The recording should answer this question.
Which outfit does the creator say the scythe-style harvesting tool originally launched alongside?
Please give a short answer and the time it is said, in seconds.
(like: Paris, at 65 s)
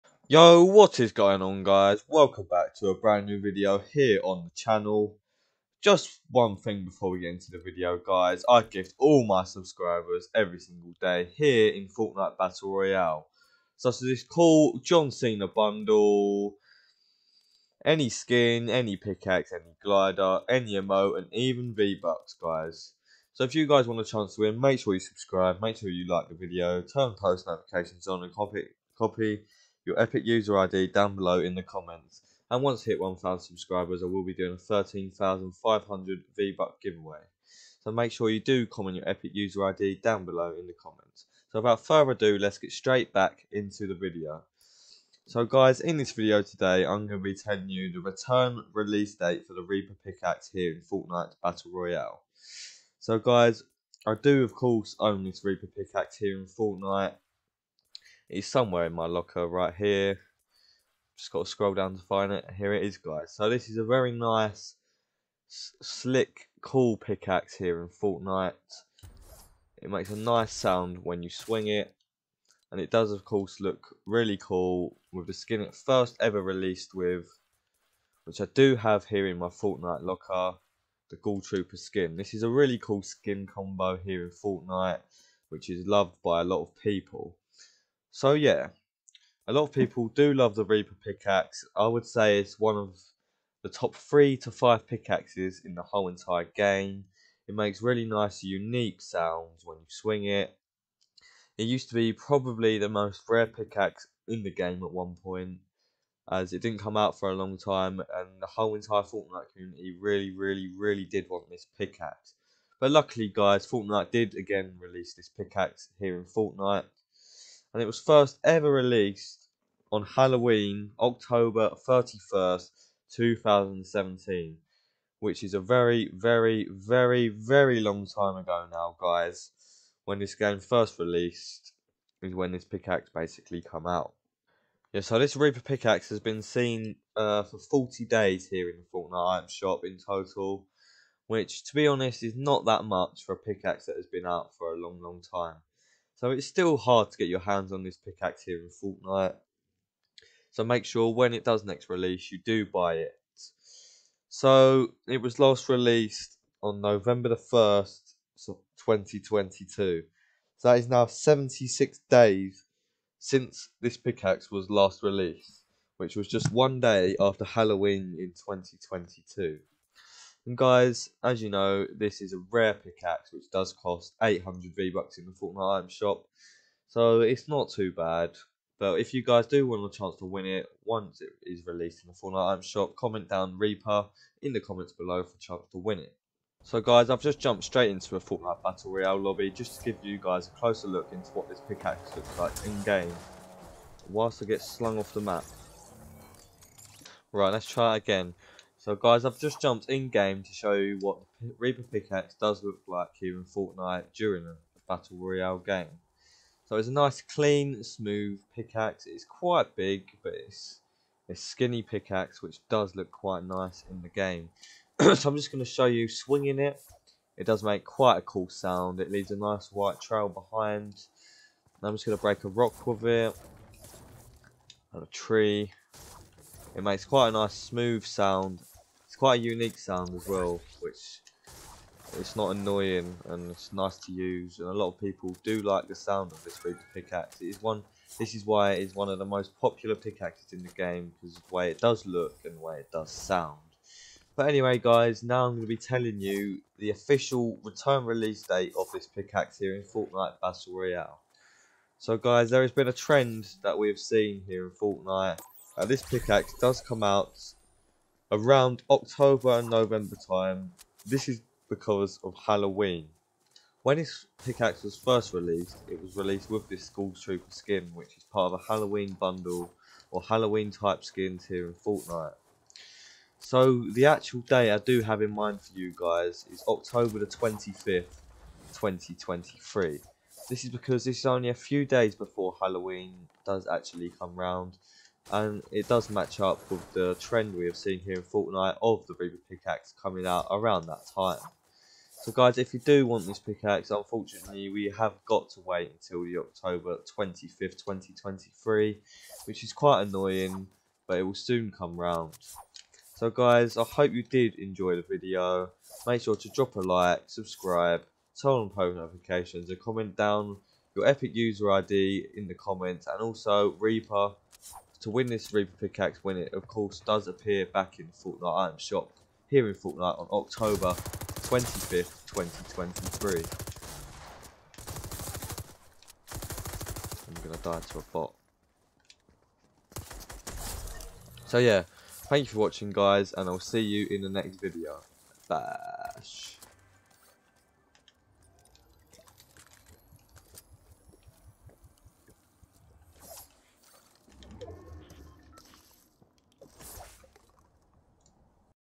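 Ghoul Trooper, at 81 s.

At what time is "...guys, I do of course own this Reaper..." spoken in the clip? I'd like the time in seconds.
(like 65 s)
53 s.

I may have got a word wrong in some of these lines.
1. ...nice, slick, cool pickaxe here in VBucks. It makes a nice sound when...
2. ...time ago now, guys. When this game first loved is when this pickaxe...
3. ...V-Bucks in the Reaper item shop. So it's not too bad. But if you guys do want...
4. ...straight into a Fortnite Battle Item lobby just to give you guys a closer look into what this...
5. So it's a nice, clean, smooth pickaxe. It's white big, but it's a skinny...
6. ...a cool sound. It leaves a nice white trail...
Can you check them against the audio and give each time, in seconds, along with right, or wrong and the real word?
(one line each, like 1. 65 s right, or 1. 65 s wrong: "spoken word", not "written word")
1. 64 s wrong: "Fortnite", not "VBucks"
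2. 128 s wrong: "released", not "loved"
3. 174 s wrong: "Fortnite", not "Reaper"
4. 187 s wrong: "Royale", not "Item"
5. 206 s wrong: "quite", not "white"
6. 218 s right.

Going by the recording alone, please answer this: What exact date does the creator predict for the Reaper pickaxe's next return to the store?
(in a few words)
October 25th, 2023.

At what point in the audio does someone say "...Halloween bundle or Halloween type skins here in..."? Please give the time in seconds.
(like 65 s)
268 s.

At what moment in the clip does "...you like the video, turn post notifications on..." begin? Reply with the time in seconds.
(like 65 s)
25 s.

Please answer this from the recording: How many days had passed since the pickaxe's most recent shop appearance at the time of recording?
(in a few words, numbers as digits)
76.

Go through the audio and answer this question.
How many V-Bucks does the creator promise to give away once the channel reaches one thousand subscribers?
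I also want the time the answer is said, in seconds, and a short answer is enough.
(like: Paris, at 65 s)
13,500, at 34 s.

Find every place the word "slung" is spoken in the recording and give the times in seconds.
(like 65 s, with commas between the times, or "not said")
194 s.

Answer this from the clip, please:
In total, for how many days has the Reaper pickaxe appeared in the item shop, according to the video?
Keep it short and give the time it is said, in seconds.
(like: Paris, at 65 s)
40, at 137 s.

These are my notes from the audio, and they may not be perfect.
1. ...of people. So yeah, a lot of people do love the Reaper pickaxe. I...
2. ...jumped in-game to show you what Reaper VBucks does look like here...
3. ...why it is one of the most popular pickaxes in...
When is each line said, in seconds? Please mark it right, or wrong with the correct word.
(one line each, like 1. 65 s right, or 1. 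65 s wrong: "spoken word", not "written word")
1. 86 s right
2. 199 s wrong: "Pickaxe", not "VBucks"
3. 238 s right.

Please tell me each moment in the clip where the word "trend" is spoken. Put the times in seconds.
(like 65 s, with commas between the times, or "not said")
252 s, 287 s.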